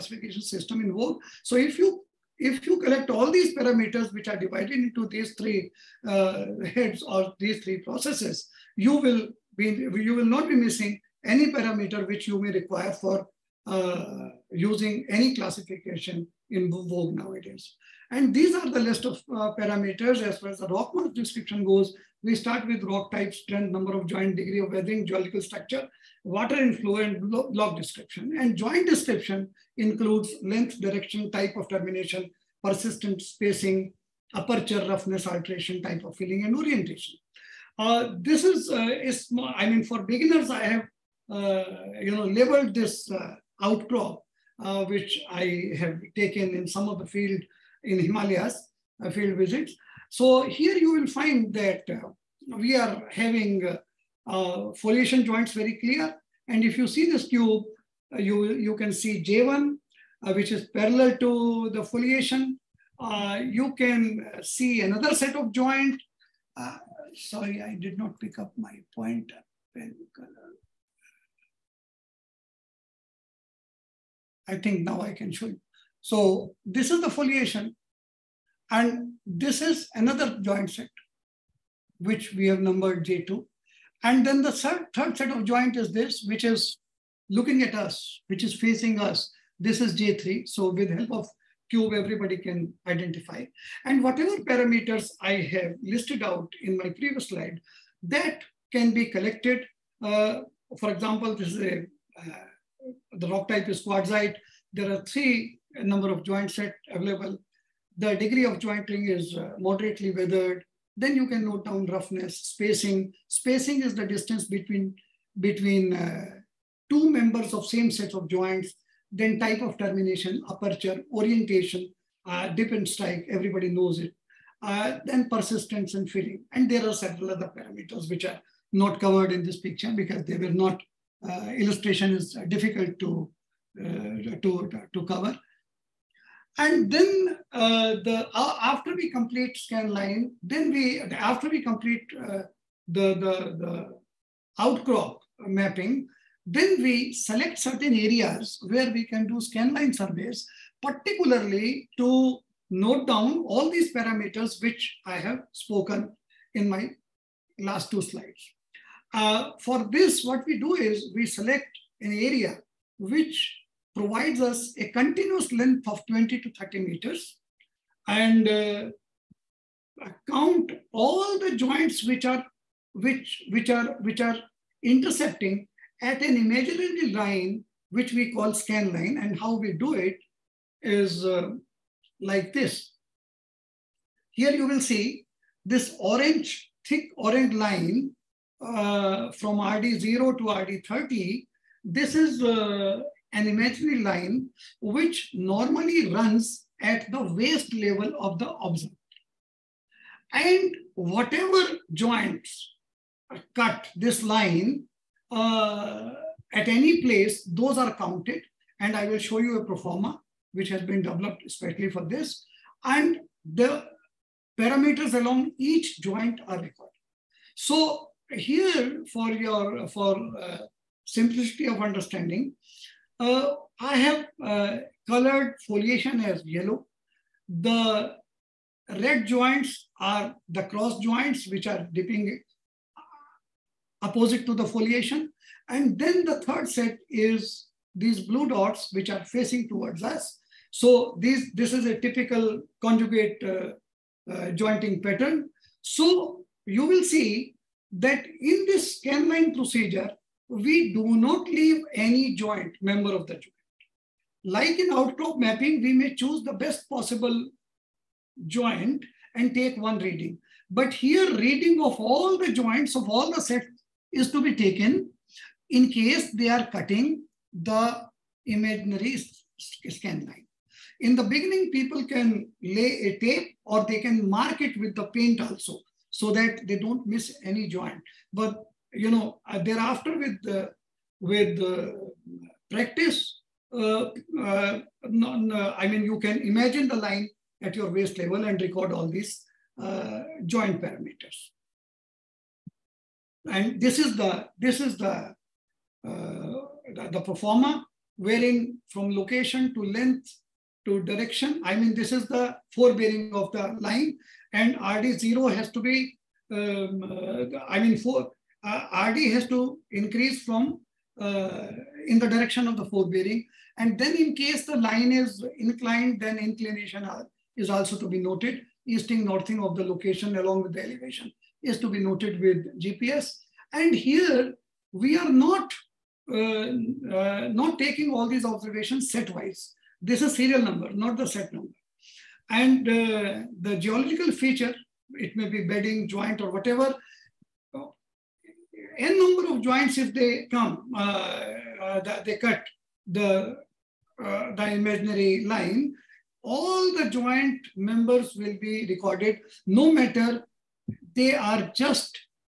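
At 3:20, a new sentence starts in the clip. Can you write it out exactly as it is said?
And whatever joints cut this line uh, at any place, those are counted.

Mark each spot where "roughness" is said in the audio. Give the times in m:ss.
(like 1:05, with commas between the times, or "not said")
0:34, 1:51.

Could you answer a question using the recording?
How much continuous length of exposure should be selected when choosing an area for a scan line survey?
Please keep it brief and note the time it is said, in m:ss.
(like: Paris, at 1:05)
20 to 30 meters, at 2:46.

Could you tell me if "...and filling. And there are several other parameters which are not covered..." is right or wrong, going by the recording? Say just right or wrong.
right.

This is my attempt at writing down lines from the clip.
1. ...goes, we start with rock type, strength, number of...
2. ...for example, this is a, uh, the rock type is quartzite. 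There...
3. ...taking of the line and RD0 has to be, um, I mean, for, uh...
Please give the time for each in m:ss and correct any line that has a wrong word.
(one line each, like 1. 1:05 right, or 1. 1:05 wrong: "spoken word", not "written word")
1. 0:21 right
2. 1:40 right
3. 5:02 wrong: "forebearing", not "taking".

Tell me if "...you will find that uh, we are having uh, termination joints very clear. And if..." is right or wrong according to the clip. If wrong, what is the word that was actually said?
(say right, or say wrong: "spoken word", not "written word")
wrong: "foliation", not "termination".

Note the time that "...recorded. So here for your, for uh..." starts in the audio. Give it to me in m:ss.
3:36.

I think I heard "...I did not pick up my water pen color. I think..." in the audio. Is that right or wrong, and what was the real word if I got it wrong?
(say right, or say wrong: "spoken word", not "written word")
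wrong: "pointer", not "water".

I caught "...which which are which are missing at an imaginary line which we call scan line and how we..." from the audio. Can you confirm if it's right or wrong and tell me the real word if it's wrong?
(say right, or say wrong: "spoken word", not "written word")
wrong: "intercepting", not "missing".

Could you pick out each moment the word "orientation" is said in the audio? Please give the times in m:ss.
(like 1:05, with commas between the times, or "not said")
0:36, 2:01.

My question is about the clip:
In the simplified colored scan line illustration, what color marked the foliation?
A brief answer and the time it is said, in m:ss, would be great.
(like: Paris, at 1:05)
yellow, at 3:46.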